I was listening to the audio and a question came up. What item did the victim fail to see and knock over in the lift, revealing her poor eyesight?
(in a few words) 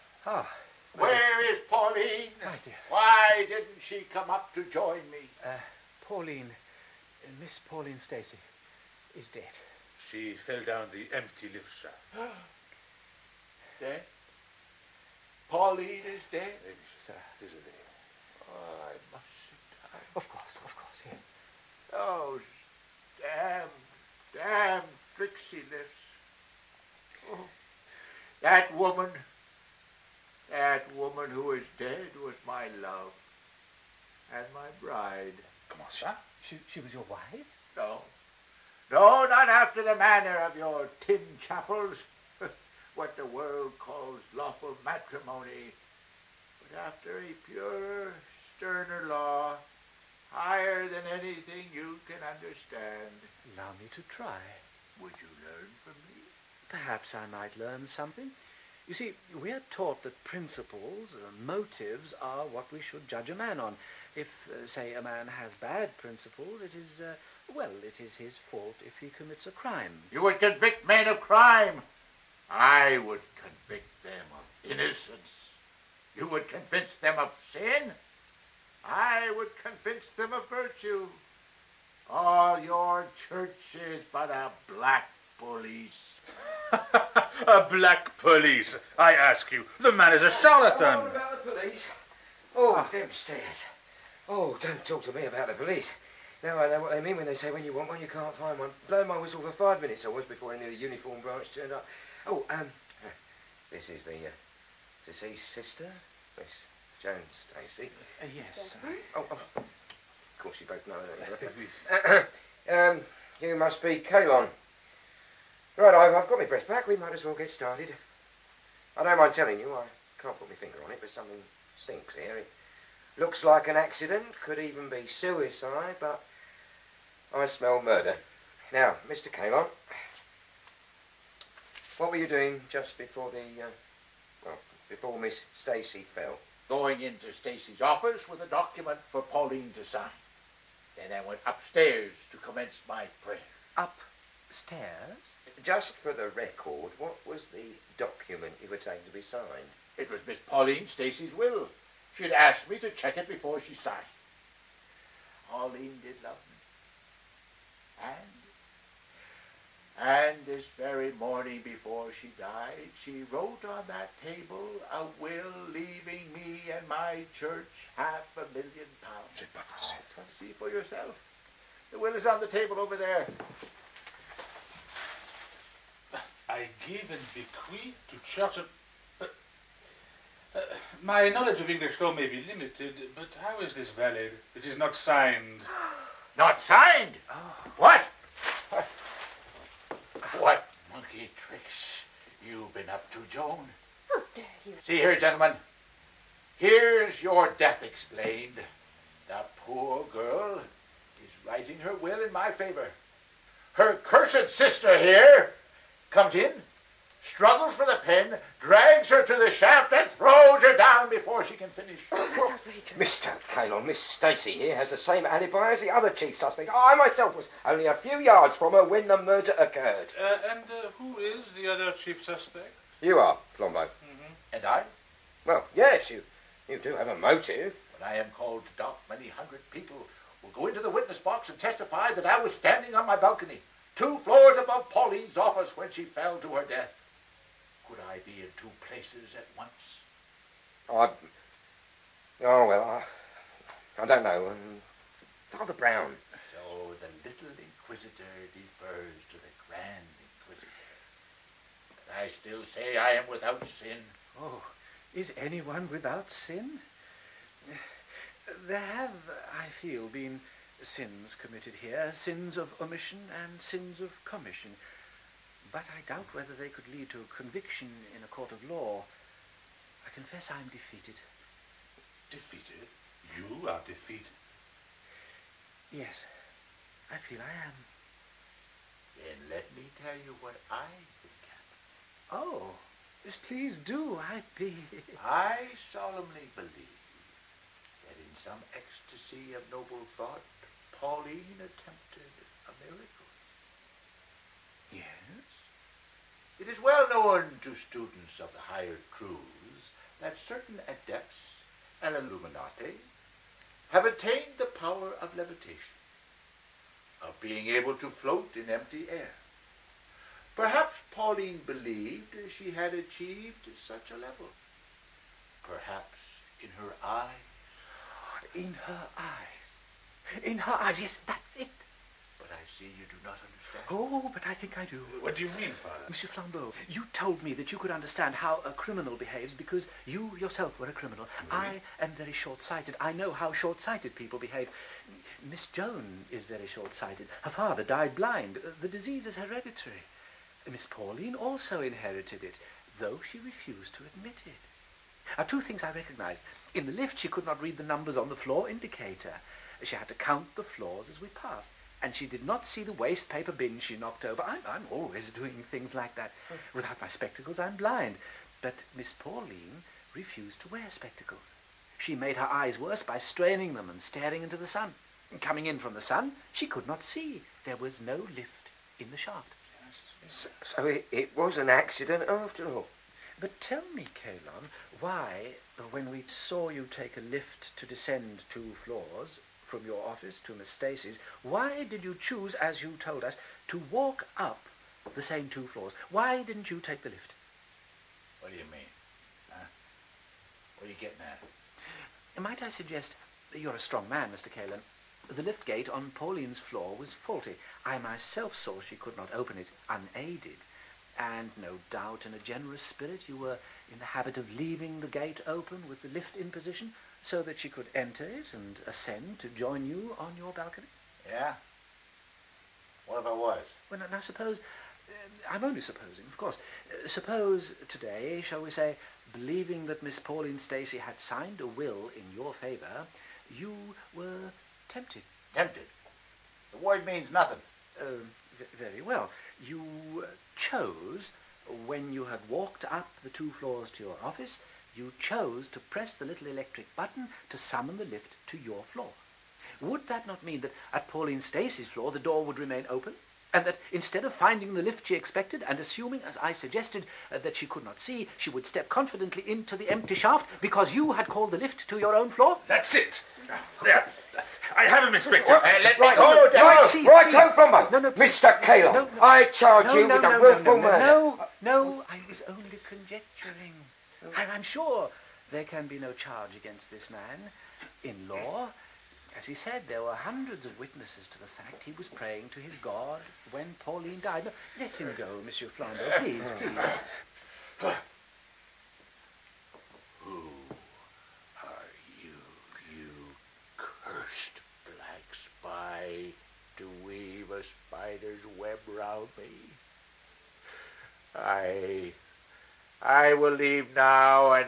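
Waste paper bin.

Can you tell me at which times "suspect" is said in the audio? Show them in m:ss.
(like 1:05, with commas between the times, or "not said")
3:36, 3:42.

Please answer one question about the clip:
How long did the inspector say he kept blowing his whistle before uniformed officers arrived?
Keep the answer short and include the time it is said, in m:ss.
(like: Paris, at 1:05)
5 minutes, at 1:39.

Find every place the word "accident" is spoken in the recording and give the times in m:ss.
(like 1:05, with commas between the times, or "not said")
2:03, 6:11.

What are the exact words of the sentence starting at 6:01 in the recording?
She made her eyes worse by straining them and staring into the sun.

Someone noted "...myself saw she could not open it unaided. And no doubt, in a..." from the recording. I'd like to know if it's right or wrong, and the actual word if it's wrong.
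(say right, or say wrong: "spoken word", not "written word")
right.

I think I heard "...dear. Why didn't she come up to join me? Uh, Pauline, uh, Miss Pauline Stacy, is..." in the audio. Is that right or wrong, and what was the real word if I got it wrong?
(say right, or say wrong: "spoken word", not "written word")
right.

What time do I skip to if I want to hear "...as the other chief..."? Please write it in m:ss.
3:35.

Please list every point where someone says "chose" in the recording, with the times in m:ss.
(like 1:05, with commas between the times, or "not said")
7:10, 7:15.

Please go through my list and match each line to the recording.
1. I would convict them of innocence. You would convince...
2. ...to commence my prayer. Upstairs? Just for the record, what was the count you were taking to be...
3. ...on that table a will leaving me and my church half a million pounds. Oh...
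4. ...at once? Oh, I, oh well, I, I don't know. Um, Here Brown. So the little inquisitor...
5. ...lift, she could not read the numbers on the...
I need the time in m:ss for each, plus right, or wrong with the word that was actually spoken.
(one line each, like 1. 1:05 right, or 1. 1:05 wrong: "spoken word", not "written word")
1. 1:12 right
2. 2:22 wrong: "document", not "count"
3. 2:43 right
4. 3:59 wrong: "Father", not "Here"
5. 5:46 right.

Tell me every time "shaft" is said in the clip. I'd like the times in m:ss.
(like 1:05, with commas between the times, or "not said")
0:11, 3:29, 6:09, 7:30.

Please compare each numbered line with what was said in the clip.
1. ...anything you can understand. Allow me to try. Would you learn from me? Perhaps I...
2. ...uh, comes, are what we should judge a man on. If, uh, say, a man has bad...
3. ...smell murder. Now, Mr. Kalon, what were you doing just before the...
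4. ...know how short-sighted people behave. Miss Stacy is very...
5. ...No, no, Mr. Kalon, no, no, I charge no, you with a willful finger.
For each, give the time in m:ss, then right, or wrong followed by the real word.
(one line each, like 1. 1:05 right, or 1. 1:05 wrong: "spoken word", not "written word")
1. 0:51 right
2. 1:01 wrong: "motives", not "comes"
3. 2:07 right
4. 5:33 wrong: "Joan", not "Stacy"
5. 7:37 wrong: "murder", not "finger".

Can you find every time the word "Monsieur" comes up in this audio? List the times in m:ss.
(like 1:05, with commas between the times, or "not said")
5:26, 7:55.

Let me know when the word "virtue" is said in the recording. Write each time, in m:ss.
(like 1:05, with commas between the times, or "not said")
1:20.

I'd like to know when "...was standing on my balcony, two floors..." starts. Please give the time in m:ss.
3:52.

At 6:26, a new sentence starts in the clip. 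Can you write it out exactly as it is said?
Why didn't you take the lift?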